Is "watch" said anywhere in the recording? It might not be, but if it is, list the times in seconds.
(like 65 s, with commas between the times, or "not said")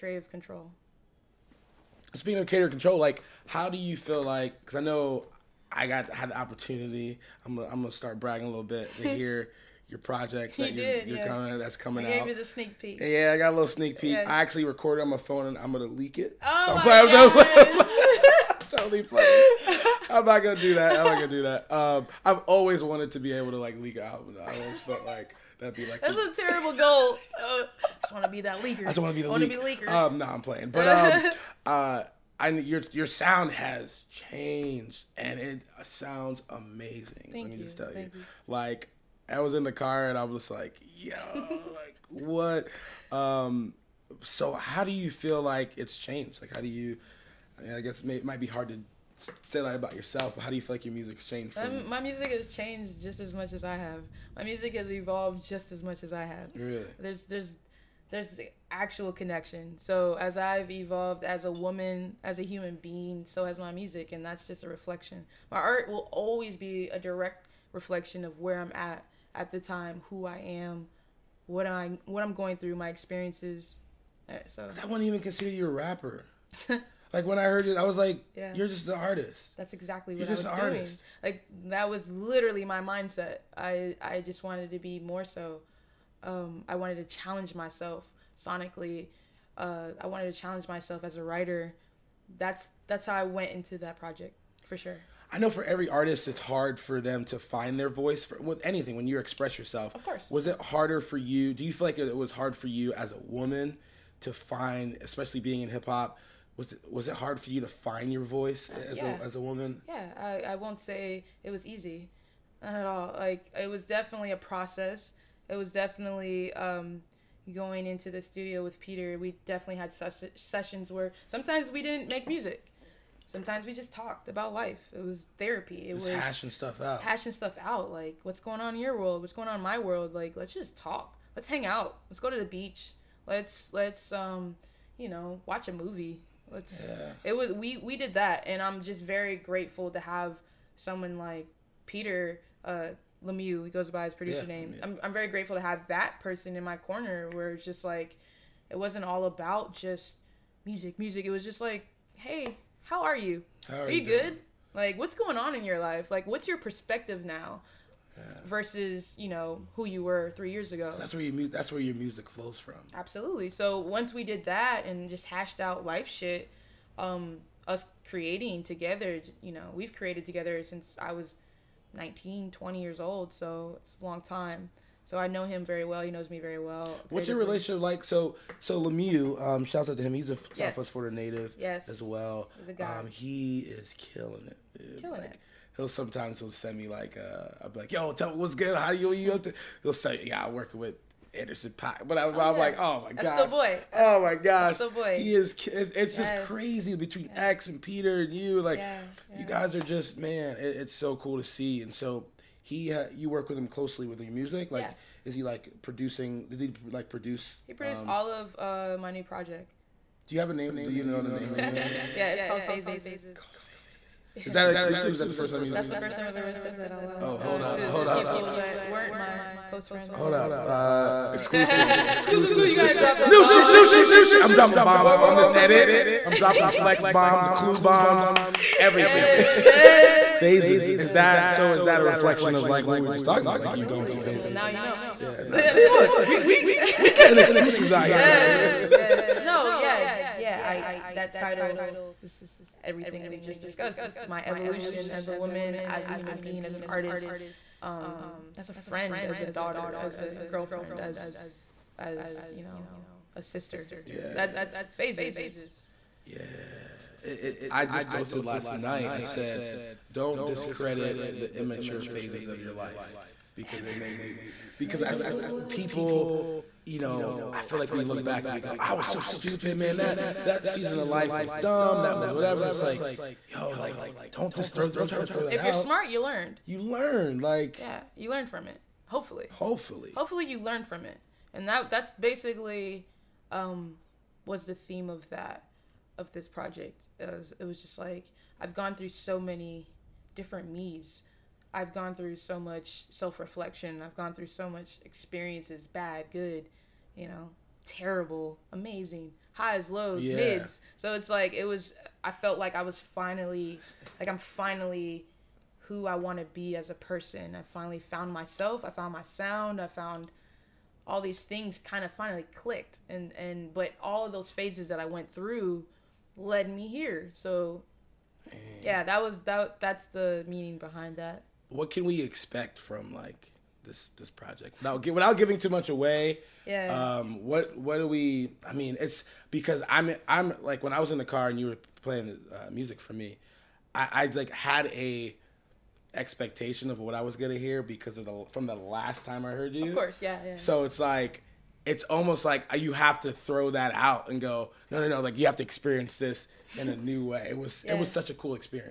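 135 s.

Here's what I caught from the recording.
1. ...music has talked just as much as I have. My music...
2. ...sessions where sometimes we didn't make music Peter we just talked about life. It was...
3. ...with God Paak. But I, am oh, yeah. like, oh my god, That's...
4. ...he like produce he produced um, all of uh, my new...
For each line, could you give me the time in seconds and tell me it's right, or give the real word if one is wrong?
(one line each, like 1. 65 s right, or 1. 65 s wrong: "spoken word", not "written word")
1. 52 s wrong: "changed", not "talked"
2. 120 s wrong: "Sometimes", not "Peter"
3. 190 s wrong: "Anderson", not "God"
4. 206 s right.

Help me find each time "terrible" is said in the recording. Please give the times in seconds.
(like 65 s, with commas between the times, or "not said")
26 s, 297 s.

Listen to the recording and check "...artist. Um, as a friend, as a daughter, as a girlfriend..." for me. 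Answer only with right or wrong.
right.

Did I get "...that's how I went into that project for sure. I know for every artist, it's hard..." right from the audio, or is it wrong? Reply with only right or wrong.
right.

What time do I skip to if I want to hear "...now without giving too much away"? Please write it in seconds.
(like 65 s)
324 s.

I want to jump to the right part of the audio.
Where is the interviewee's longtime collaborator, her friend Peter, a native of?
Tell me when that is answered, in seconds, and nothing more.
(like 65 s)
180 s.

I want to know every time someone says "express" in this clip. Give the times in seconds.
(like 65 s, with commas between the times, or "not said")
99 s.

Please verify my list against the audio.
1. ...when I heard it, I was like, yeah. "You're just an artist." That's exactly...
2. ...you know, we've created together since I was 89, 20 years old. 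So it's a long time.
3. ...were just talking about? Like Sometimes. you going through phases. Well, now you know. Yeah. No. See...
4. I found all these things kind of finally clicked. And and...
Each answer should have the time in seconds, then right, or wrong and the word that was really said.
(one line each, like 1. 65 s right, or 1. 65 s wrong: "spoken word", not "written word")
1. 77 s right
2. 169 s wrong: "19", not "89"
3. 233 s wrong: "Absolutely", not "Sometimes"
4. 309 s right.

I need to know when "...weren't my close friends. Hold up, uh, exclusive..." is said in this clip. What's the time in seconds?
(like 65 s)
218 s.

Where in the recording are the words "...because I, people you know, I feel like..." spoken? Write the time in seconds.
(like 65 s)
264 s.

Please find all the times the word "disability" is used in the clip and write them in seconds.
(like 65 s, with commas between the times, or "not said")
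not said.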